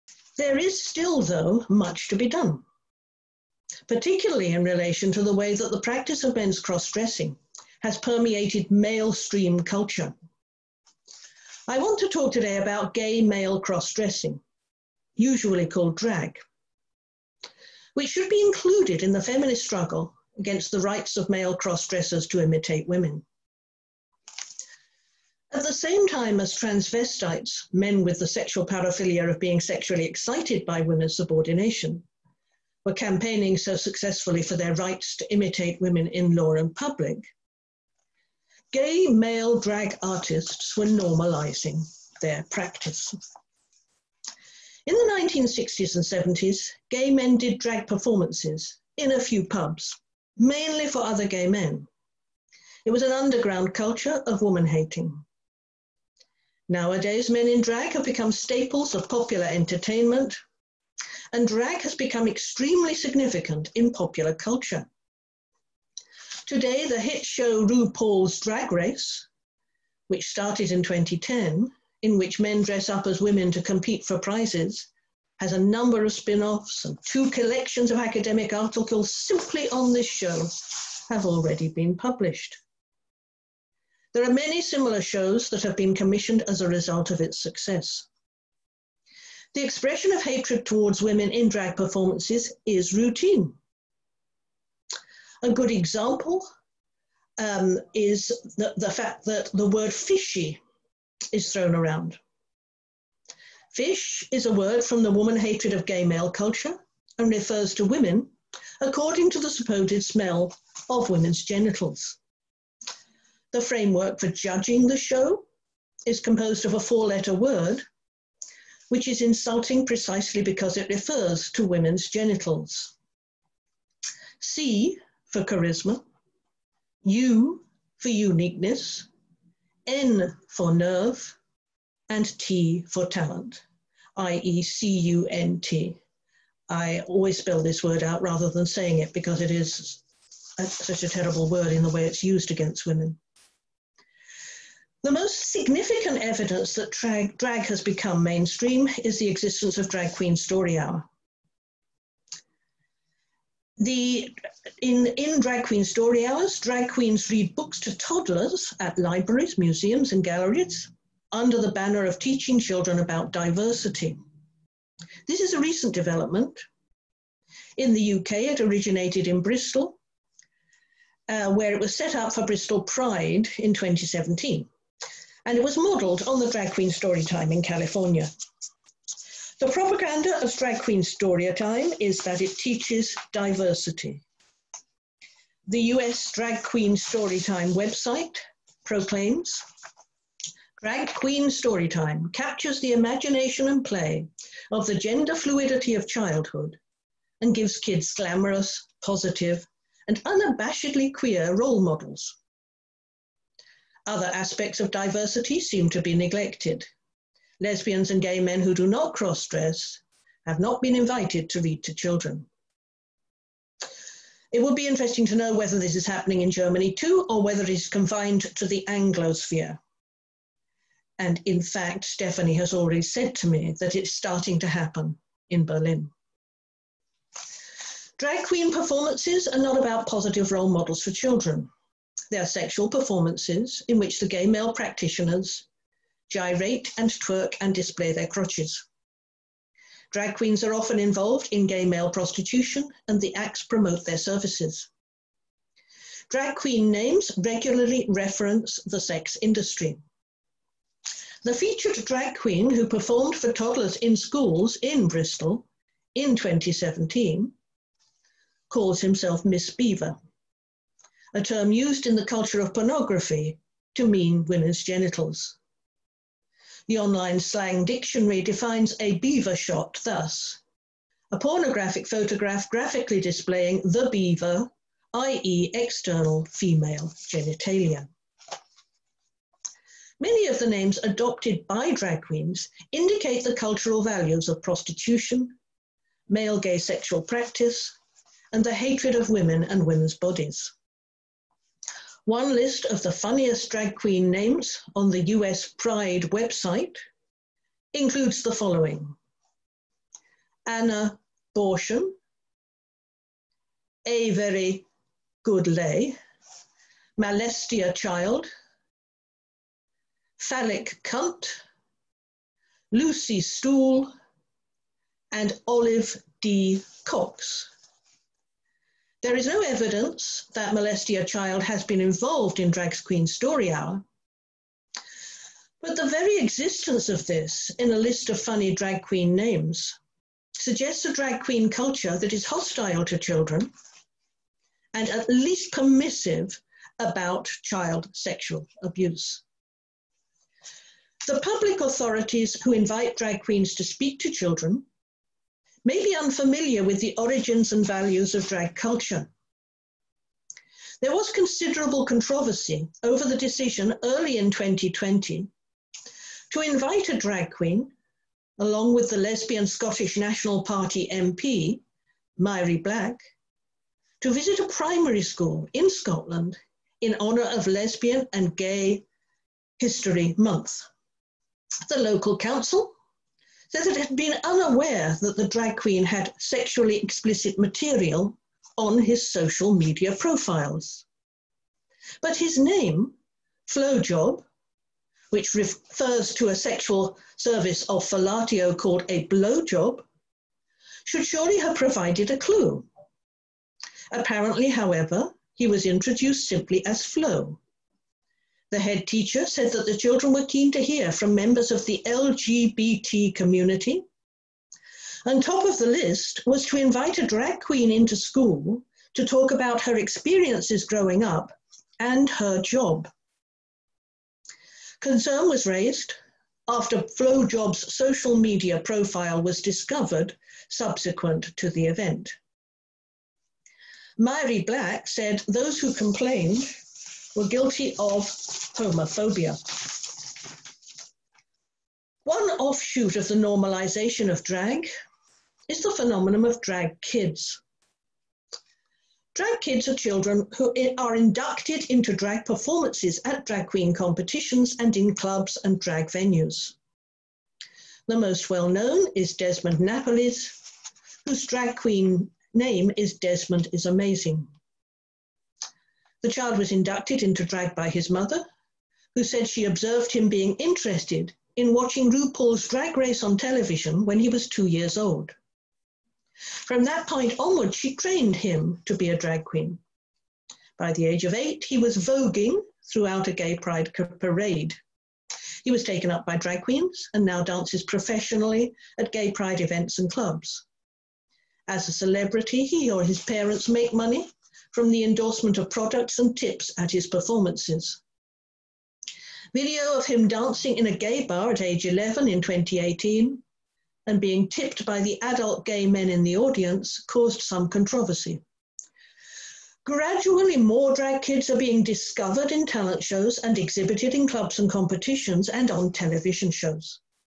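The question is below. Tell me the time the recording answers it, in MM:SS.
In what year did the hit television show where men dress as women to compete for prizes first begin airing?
01:10.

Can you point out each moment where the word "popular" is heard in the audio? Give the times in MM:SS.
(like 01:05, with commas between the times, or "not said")
00:59, 01:03.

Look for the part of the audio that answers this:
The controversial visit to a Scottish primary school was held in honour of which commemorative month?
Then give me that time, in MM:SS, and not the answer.
06:07.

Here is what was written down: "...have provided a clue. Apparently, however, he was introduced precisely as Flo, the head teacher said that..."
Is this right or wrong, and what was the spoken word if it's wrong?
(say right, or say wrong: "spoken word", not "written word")
wrong: "simply", not "precisely".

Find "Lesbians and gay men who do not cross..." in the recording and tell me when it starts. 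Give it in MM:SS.
03:27.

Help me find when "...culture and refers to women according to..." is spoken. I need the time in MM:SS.
01:46.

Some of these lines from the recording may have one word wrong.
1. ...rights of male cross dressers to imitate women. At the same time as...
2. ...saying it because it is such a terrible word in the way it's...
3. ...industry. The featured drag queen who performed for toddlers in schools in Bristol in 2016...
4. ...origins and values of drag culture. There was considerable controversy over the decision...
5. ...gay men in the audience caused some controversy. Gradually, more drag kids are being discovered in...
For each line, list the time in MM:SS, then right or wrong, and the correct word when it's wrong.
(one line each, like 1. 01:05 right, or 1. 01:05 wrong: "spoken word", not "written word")
1. 00:20 right
2. 02:18 right
3. 04:09 wrong: "2017", not "2016"
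4. 05:47 right
5. 08:15 right.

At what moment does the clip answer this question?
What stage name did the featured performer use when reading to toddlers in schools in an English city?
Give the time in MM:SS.
04:19.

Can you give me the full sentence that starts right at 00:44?
In the 1960s and 70s, gay men did drag performances in a few pubs, mainly for other gay men.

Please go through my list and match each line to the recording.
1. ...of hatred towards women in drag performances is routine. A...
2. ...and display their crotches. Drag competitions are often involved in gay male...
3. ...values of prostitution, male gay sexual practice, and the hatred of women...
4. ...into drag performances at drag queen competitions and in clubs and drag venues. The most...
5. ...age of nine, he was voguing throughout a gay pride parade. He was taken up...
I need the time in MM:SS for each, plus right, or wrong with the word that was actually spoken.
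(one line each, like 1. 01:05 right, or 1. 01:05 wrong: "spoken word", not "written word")
1. 01:30 right
2. 03:57 wrong: "queens", not "competitions"
3. 04:44 right
4. 07:21 right
5. 07:51 wrong: "eight", not "nine".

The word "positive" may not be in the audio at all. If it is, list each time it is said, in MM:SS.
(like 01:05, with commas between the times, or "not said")
03:19, 03:50.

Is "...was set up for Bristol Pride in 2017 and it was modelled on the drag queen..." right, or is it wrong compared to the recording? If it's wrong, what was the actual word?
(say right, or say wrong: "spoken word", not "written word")
right.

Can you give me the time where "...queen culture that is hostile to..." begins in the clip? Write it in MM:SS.
05:31.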